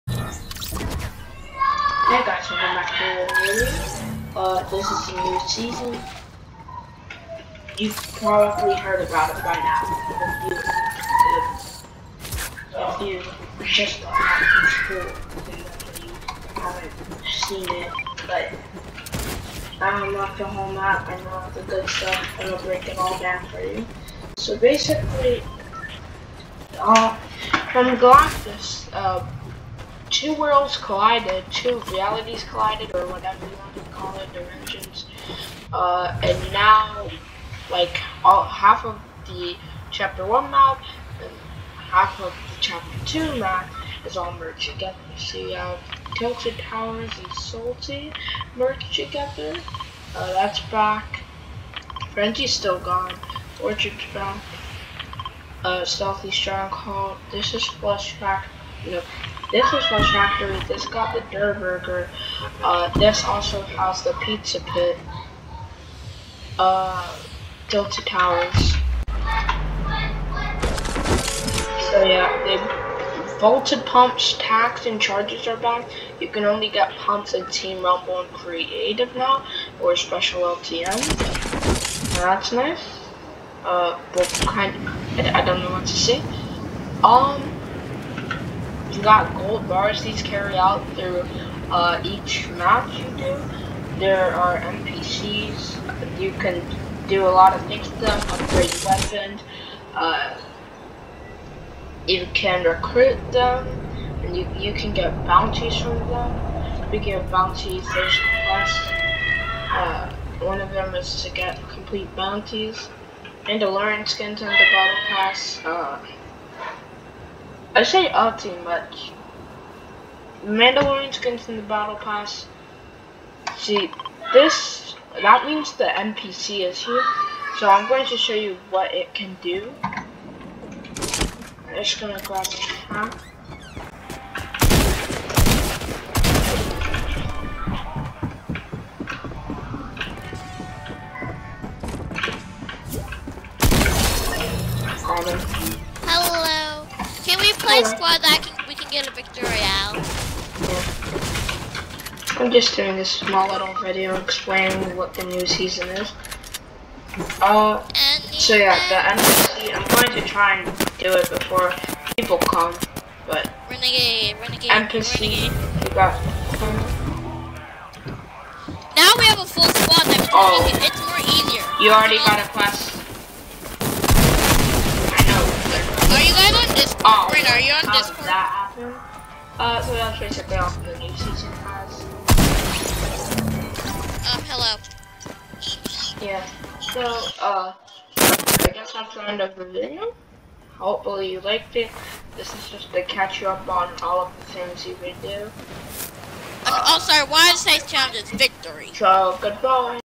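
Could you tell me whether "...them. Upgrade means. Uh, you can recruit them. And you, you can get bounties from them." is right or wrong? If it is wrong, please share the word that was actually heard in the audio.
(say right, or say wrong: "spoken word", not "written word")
wrong: "weapons", not "means".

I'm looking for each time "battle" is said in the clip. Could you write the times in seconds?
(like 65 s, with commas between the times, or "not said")
114 s, 121 s.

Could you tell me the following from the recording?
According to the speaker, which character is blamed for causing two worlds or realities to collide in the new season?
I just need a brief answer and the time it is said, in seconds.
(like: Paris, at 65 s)
Galactus, at 27 s.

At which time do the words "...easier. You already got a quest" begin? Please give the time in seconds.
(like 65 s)
171 s.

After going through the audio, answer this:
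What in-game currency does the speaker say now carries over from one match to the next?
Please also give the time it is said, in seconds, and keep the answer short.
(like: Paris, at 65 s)
gold bars, at 89 s.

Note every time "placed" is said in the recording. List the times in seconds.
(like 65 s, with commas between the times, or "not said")
not said.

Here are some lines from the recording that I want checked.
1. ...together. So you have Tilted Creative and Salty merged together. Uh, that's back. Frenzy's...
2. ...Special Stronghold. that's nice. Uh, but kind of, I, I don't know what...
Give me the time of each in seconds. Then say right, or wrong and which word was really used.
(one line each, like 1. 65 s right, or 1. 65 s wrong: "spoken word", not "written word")
1. 44 s wrong: "Towers", not "Creative"
2. 79 s wrong: "LTM", not "Stronghold".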